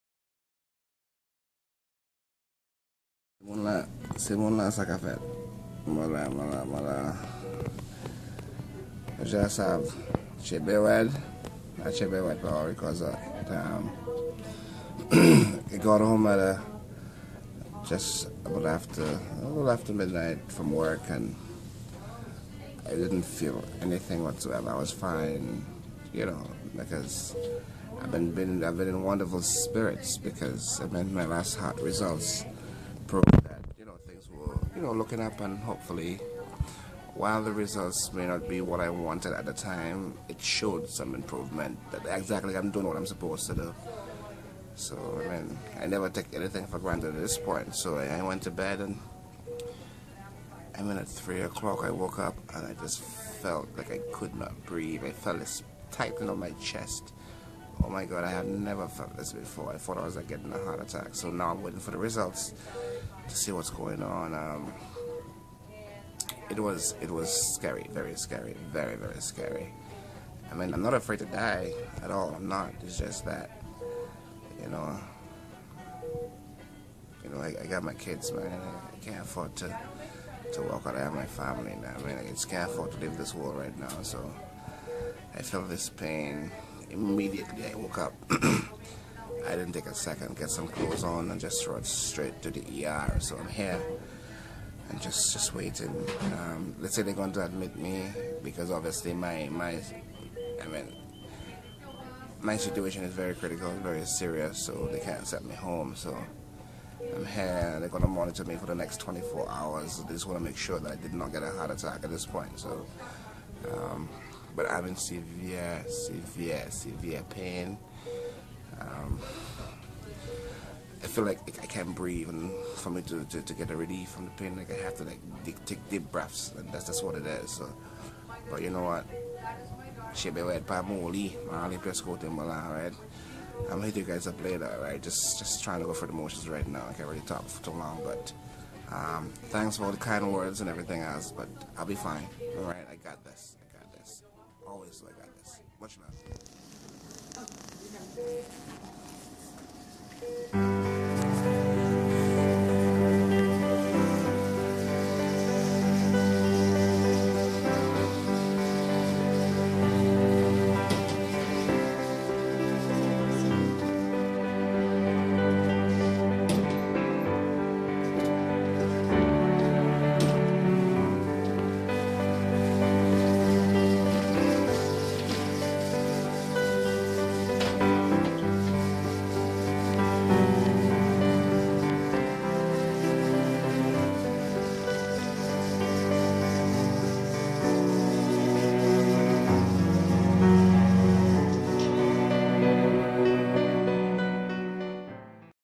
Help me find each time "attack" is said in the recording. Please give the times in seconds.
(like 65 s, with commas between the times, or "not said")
60 s, 111 s.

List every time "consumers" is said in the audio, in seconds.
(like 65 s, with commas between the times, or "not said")
not said.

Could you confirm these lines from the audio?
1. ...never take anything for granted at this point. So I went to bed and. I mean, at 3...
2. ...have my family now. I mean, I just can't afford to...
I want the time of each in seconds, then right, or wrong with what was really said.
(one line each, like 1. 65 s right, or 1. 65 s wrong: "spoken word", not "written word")
1. 45 s right
2. 80 s right.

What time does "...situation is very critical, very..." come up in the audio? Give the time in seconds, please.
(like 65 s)
102 s.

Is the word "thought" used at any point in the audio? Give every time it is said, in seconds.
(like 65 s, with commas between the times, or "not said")
59 s.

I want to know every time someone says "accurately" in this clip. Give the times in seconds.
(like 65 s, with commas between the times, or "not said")
not said.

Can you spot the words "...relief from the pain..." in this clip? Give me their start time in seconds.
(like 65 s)
123 s.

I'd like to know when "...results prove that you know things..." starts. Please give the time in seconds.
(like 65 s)
31 s.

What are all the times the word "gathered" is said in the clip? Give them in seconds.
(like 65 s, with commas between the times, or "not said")
not said.